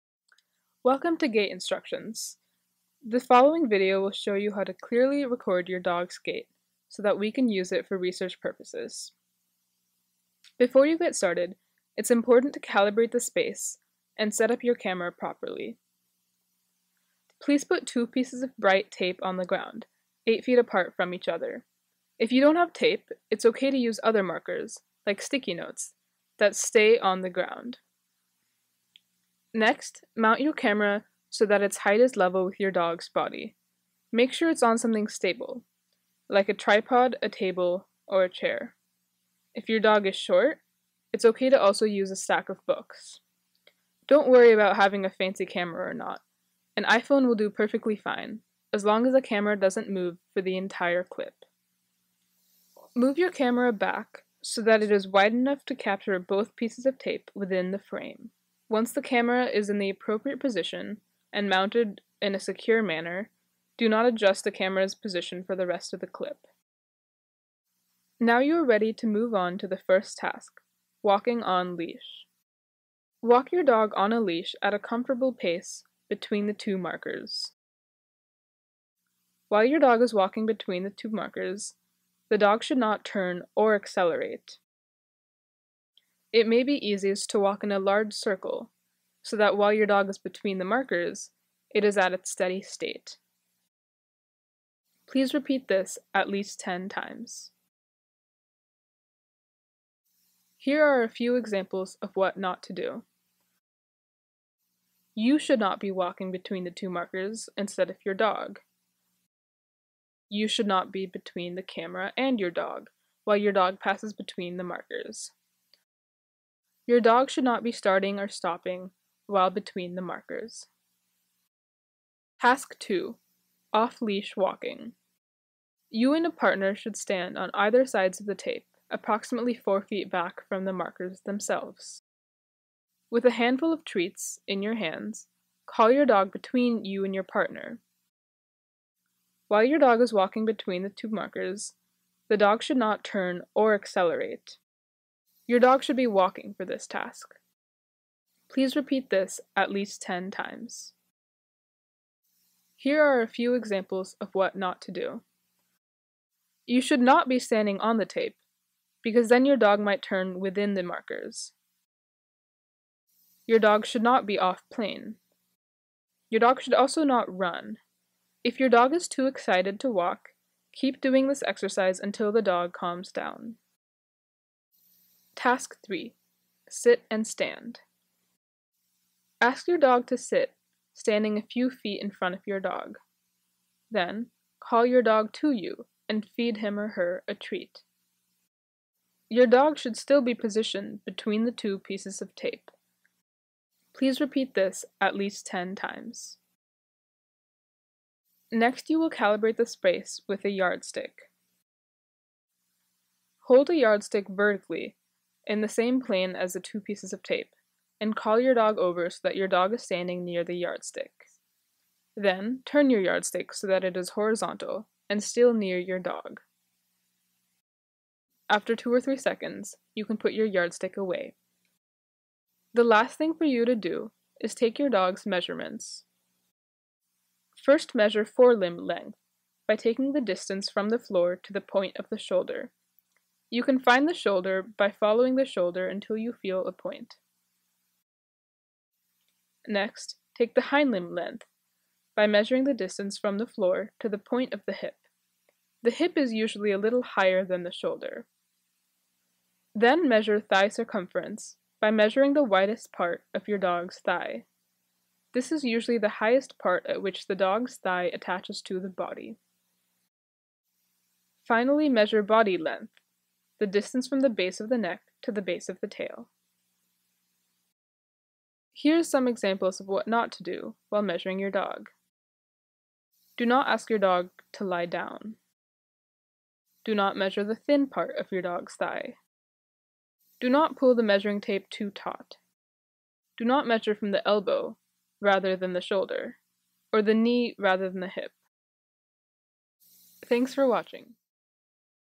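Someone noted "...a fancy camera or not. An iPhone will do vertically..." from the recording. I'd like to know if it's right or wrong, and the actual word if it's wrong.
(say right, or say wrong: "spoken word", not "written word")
wrong: "perfectly", not "vertically".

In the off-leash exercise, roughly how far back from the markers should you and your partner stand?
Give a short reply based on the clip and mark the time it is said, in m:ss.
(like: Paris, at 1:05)
4 feet, at 2:09.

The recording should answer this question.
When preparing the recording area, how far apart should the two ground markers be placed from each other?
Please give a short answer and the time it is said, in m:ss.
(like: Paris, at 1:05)
8 feet, at 0:20.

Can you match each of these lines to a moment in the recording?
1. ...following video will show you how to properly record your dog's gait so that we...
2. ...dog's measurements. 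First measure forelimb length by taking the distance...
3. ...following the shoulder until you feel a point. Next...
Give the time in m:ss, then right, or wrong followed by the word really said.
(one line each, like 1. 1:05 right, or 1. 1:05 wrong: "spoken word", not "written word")
1. 0:03 wrong: "clearly", not "properly"
2. 3:44 right
3. 3:54 right.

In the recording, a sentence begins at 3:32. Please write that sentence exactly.
Then, turn your yardstick so that it is horizontal and still near your dog.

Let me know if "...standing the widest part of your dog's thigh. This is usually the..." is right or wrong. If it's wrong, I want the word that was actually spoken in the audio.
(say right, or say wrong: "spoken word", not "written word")
wrong: "measuring", not "standing".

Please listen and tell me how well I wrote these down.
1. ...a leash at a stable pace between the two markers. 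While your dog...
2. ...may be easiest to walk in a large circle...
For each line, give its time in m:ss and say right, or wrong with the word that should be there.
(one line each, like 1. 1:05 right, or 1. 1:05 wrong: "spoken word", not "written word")
1. 1:14 wrong: "comfortable", not "stable"
2. 1:26 right.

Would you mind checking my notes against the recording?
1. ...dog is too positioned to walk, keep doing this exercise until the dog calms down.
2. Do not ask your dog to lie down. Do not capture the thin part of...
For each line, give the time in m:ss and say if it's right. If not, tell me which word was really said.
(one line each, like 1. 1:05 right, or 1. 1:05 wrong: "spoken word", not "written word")
1. 2:48 wrong: "excited", not "positioned"
2. 4:33 wrong: "measure", not "capture".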